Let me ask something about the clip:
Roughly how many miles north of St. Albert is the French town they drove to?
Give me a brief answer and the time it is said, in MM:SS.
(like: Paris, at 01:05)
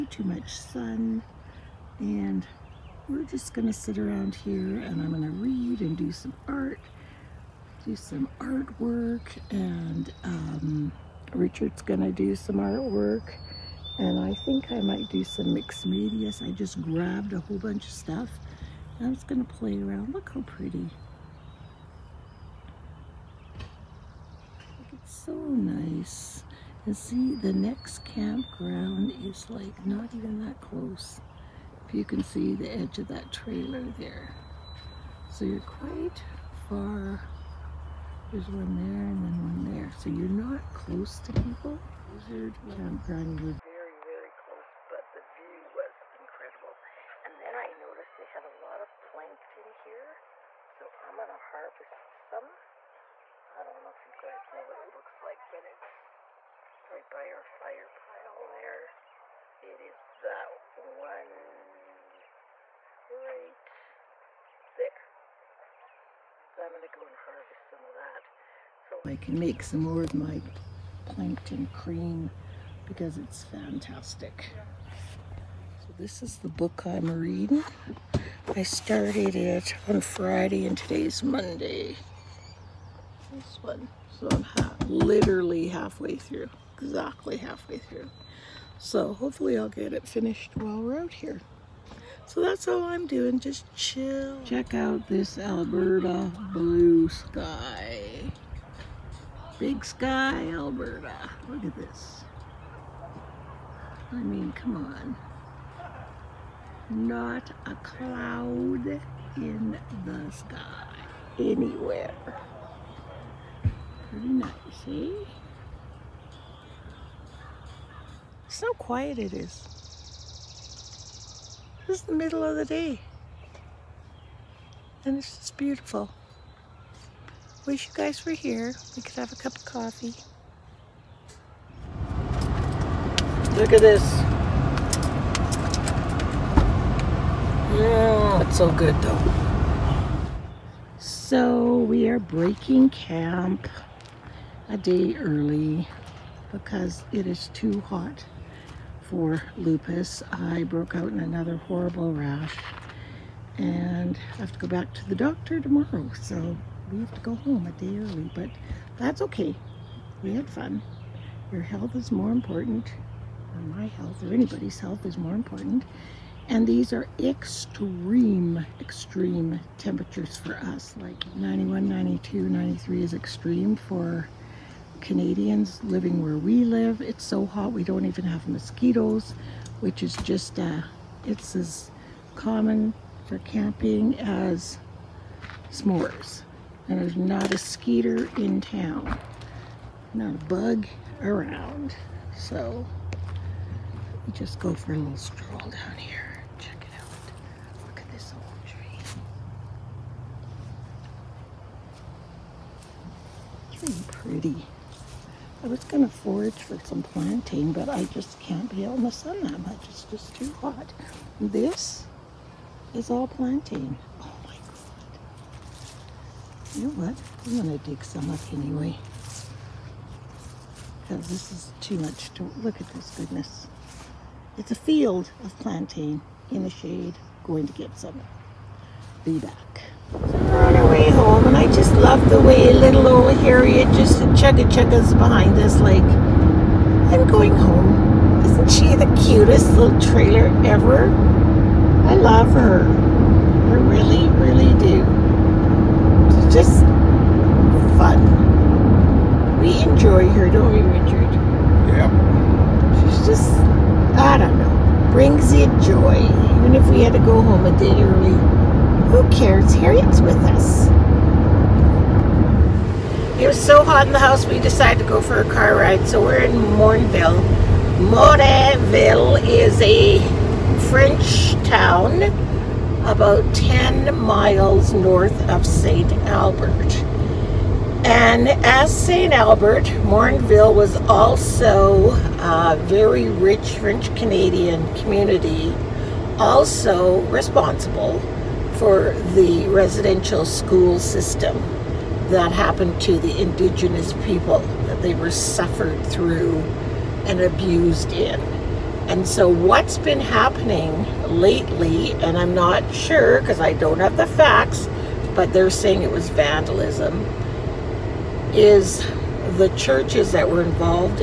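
10, at 04:33.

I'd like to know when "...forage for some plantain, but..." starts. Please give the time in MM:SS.
03:26.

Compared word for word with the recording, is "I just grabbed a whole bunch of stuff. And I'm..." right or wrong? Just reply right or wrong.
right.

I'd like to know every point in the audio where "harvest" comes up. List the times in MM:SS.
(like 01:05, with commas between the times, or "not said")
00:51, 01:07.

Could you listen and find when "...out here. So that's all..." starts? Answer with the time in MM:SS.
01:30.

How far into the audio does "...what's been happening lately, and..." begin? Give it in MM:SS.
04:59.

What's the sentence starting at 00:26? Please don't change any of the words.
And see, the next campground is like not even that close you can see the edge of that trailer there.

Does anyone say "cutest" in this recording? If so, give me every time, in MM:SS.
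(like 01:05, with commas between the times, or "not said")
03:59.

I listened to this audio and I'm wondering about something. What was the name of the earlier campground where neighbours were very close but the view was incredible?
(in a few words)
Wizard campground.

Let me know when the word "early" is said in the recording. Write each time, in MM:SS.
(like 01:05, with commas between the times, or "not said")
02:25, 02:37, 04:18.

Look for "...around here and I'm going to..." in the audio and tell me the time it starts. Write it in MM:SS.
00:03.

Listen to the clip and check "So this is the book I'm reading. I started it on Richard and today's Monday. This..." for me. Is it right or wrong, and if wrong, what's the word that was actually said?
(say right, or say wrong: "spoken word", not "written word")
wrong: "Friday", not "Richard".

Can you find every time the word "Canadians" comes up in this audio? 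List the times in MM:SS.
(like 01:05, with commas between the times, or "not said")
02:55, 04:44.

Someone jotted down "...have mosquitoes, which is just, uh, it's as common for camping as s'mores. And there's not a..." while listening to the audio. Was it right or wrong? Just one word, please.
right.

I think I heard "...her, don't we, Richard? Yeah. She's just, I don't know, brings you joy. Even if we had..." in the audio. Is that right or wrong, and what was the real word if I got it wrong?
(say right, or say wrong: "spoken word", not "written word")
right.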